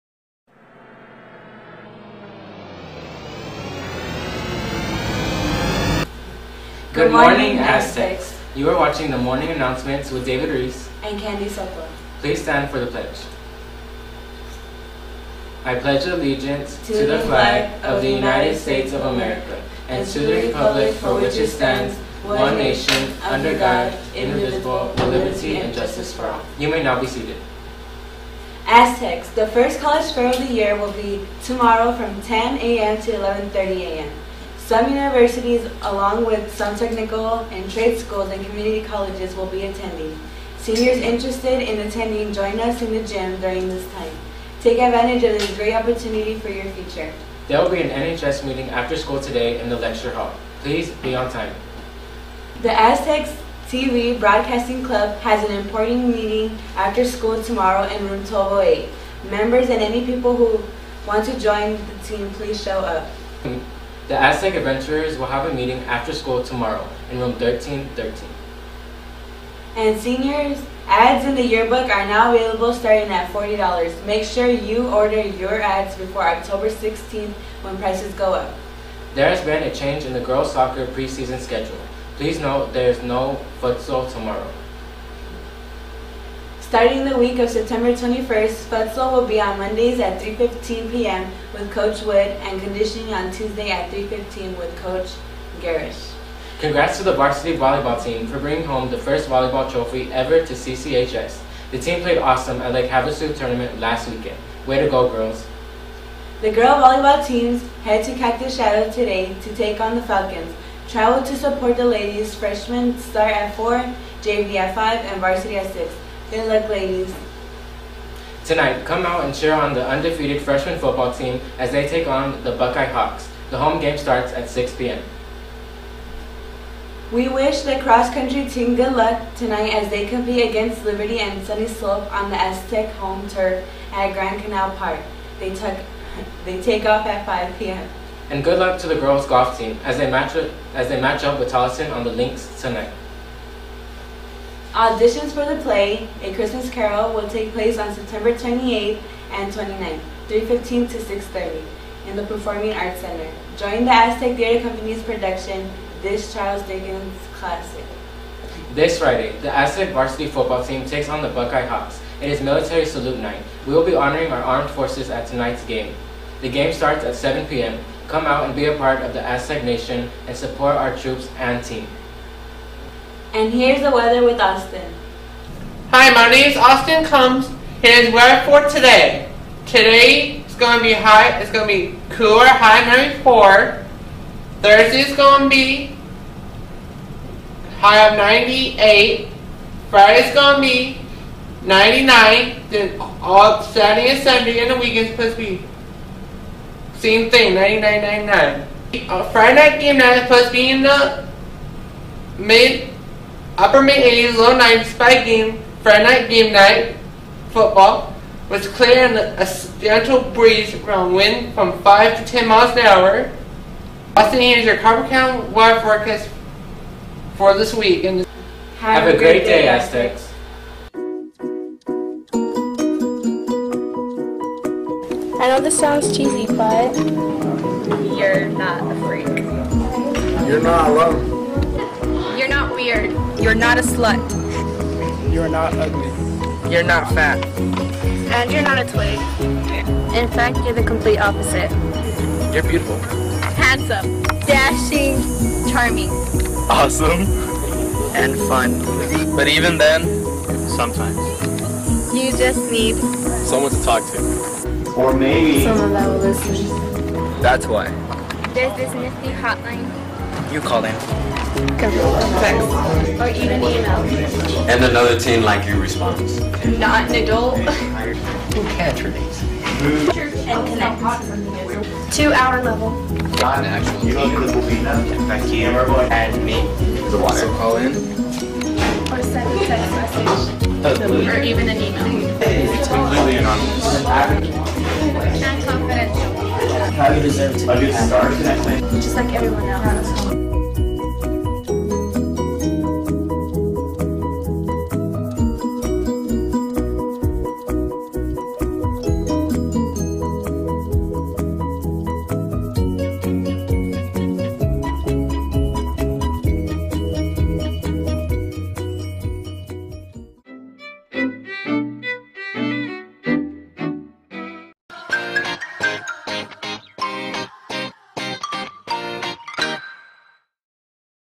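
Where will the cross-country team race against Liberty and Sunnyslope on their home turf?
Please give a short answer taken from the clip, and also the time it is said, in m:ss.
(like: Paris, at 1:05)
Grand Canal Park, at 2:14.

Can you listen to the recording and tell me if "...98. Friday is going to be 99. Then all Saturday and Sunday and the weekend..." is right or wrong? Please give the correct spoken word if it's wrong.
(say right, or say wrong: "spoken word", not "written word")
right.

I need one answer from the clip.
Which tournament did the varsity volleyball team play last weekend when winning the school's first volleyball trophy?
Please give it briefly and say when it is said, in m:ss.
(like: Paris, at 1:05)
Lake Havasu, at 1:42.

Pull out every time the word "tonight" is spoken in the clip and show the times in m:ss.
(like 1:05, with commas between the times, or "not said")
1:58, 2:09, 2:22, 2:45.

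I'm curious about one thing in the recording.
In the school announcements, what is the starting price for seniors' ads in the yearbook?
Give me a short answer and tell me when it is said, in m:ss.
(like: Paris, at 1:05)
$40, at 1:13.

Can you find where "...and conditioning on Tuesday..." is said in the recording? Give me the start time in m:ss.
1:32.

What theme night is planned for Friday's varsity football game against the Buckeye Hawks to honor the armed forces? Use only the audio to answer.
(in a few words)
Military Salute Night.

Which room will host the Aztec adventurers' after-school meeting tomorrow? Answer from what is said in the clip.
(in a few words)
1313.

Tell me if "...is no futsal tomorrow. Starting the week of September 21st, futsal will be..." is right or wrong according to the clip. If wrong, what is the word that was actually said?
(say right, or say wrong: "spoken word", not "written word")
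right.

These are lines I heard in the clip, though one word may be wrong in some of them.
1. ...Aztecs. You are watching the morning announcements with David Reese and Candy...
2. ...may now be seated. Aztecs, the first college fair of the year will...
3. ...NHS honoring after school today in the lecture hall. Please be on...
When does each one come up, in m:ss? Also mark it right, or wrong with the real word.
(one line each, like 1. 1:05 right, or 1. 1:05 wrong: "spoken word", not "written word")
1. 0:07 right
2. 0:26 right
3. 0:47 wrong: "meeting", not "honoring".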